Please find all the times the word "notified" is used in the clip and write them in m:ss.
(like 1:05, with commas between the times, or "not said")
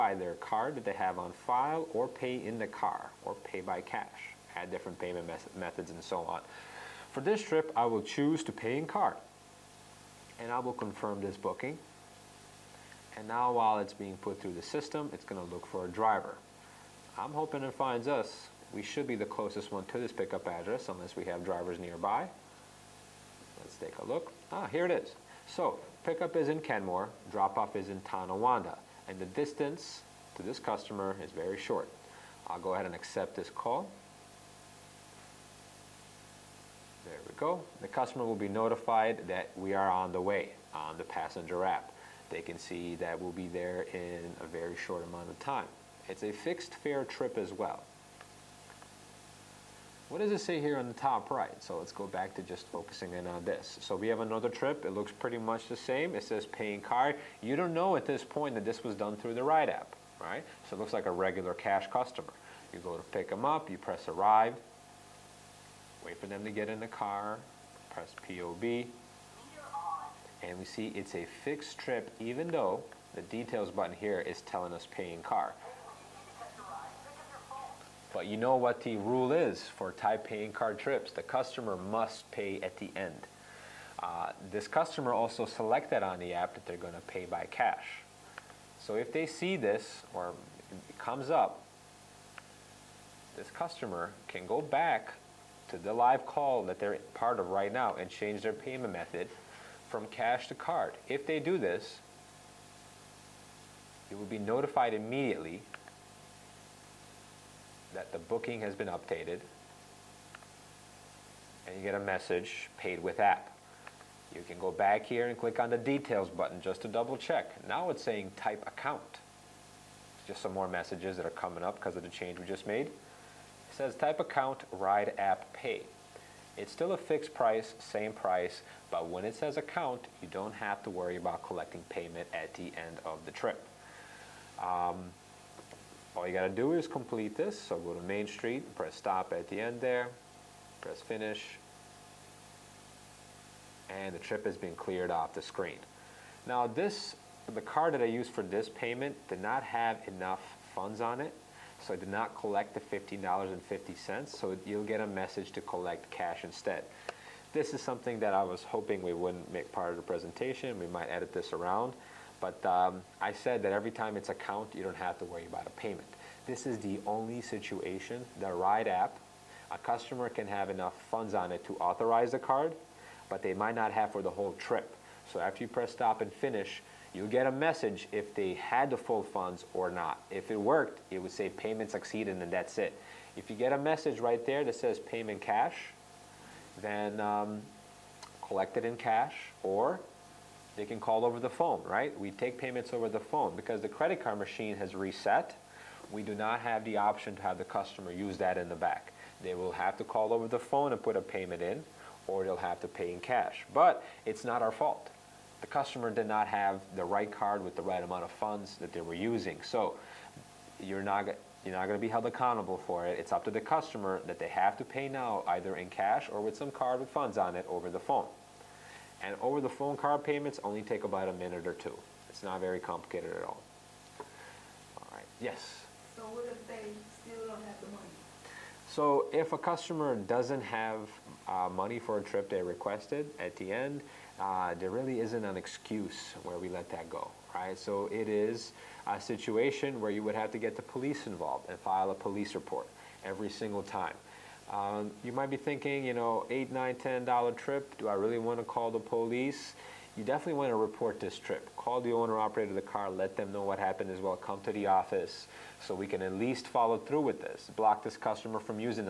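0:38, 1:44.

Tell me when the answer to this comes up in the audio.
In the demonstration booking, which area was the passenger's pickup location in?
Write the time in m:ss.
0:26.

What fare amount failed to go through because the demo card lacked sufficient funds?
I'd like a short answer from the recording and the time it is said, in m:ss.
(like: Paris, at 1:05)
$15.50, at 2:32.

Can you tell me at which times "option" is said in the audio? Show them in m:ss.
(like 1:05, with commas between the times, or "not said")
3:16.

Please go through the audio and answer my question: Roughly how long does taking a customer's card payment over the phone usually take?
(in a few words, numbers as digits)
a minute or two.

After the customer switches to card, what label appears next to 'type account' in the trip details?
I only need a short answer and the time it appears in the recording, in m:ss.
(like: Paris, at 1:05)
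Ride app pay, at 2:04.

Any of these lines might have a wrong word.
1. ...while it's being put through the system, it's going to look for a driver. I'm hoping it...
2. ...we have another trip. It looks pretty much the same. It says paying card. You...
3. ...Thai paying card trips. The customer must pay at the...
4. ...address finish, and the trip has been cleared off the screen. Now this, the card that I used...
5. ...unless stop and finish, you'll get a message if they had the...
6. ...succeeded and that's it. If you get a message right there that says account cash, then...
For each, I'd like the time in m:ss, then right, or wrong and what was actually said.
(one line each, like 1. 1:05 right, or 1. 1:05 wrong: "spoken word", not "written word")
1. 0:13 right
2. 0:53 right
3. 1:19 right
4. 2:20 wrong: "press", not "address"
5. 2:55 wrong: "press", not "unless"
6. 3:01 wrong: "payment", not "account".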